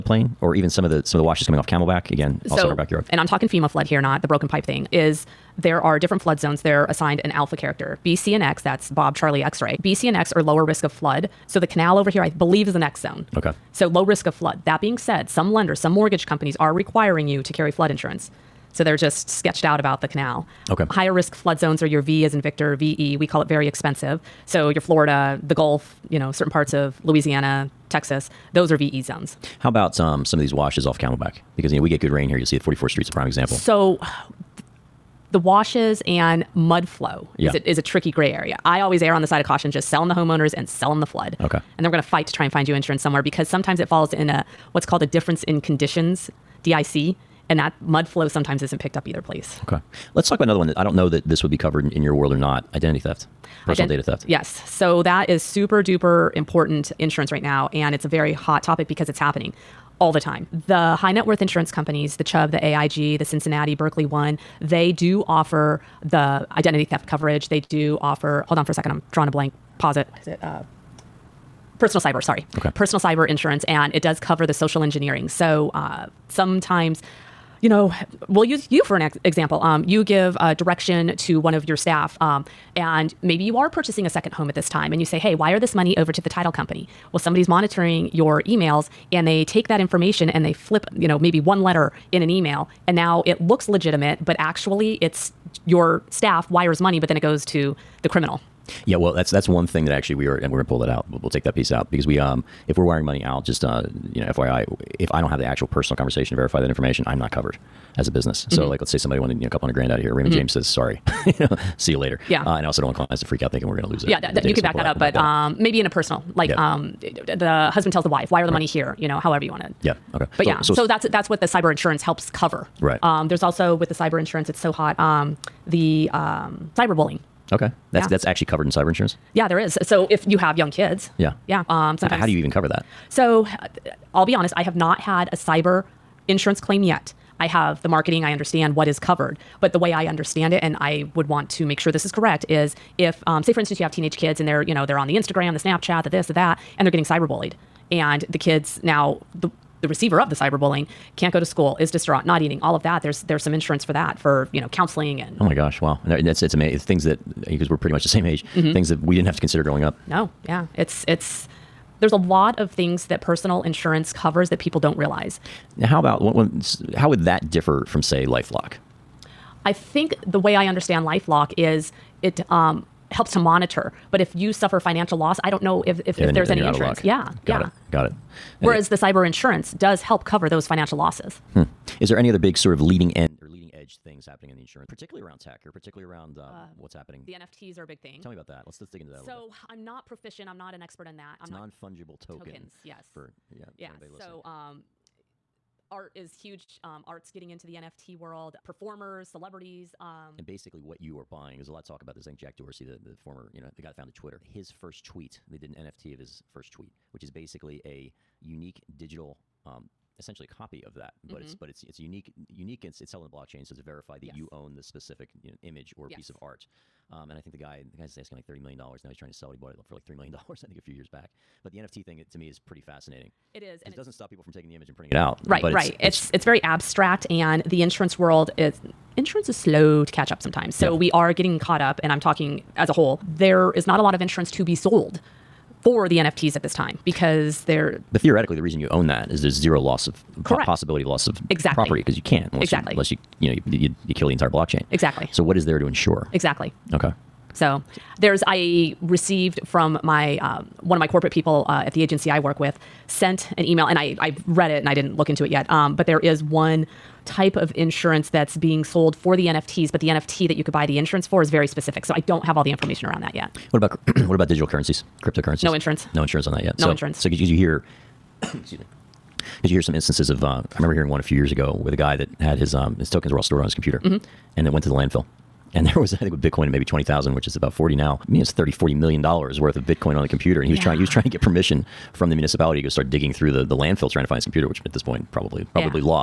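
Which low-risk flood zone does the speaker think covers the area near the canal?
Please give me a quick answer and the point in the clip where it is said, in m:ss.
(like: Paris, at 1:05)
X zone, at 0:12.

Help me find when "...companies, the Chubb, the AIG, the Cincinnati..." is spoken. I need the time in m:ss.
1:01.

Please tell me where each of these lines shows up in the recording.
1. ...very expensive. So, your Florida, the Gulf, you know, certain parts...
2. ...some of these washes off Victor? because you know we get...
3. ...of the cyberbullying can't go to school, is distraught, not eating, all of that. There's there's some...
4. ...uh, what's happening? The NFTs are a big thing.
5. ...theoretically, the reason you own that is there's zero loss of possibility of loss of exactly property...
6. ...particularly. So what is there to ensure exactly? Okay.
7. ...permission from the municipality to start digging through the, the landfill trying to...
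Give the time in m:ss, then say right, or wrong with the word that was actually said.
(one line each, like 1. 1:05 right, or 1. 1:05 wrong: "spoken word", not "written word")
1. 0:23 right
2. 0:30 wrong: "Camelback", not "Victor"
3. 2:30 right
4. 3:06 right
5. 3:58 right
6. 4:04 wrong: "exactly", not "particularly"
7. 4:41 right.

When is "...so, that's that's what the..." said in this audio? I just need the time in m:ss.
2:00.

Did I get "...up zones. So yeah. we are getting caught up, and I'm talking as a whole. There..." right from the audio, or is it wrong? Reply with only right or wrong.
wrong.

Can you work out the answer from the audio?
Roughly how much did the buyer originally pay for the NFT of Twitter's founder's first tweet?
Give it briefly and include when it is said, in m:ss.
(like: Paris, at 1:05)
$3 million, at 3:40.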